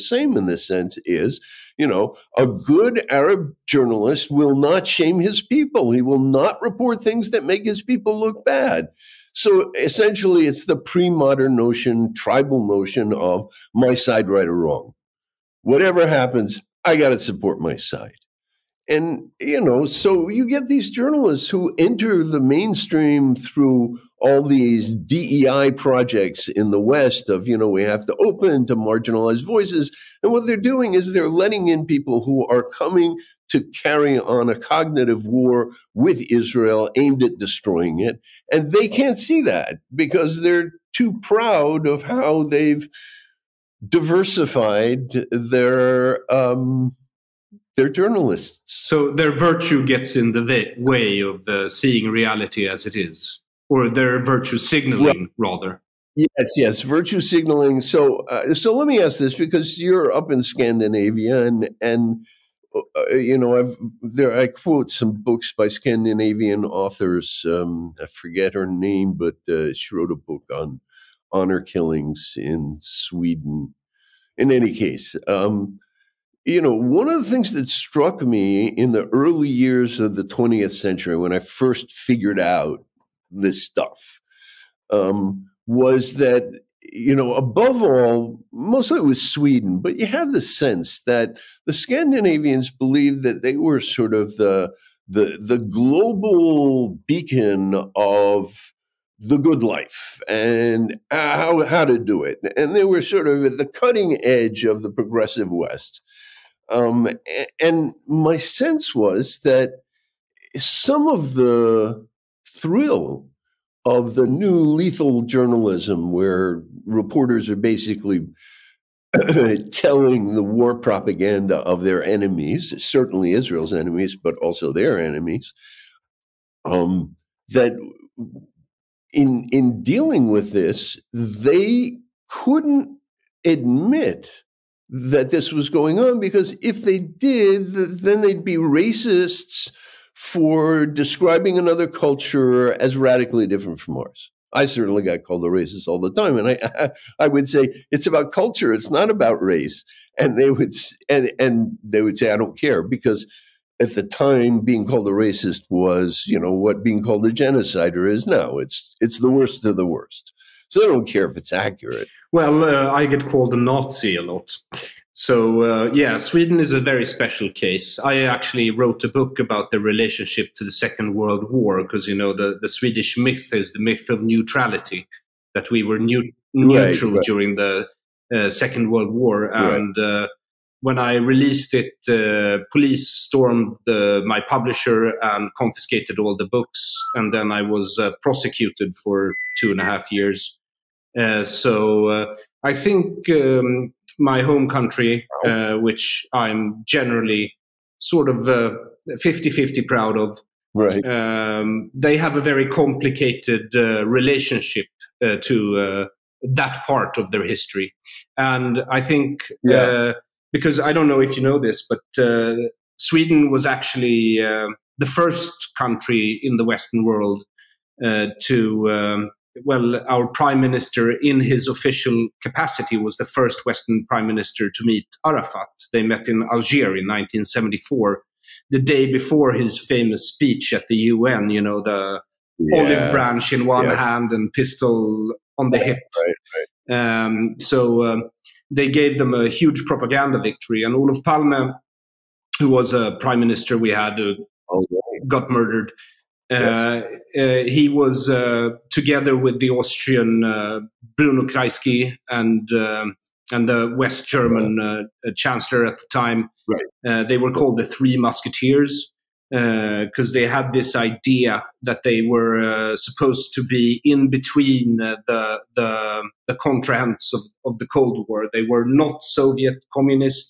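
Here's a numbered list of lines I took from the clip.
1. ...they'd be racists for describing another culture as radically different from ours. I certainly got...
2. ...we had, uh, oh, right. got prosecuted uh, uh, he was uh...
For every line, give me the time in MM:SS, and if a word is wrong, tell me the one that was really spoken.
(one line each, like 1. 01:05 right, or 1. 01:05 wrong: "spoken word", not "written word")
1. 02:18 right
2. 04:03 wrong: "murdered", not "prosecuted".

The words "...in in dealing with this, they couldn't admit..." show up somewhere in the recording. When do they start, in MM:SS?
02:09.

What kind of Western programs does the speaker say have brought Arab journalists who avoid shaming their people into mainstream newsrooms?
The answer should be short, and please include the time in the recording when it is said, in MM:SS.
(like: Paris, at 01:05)
DEI projects, at 00:24.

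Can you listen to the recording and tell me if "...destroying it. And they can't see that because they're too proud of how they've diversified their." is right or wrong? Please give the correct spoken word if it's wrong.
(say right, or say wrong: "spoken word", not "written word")
right.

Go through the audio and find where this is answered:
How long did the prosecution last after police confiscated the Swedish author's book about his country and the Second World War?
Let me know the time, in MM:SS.
03:09.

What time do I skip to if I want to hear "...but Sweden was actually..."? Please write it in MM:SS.
03:31.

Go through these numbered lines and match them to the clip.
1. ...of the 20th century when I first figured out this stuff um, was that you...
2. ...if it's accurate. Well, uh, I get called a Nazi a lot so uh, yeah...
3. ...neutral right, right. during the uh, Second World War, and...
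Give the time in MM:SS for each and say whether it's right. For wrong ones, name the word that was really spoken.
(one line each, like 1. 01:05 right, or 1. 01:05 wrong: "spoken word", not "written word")
1. 01:19 right
2. 02:41 right
3. 02:56 right.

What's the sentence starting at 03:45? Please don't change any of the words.
They met in Algiers in 1974, the day before his famous speech at the UN, you know, the yeah.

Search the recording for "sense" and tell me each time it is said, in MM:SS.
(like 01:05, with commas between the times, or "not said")
00:00, 01:30, 01:48.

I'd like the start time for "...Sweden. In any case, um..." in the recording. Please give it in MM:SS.
01:12.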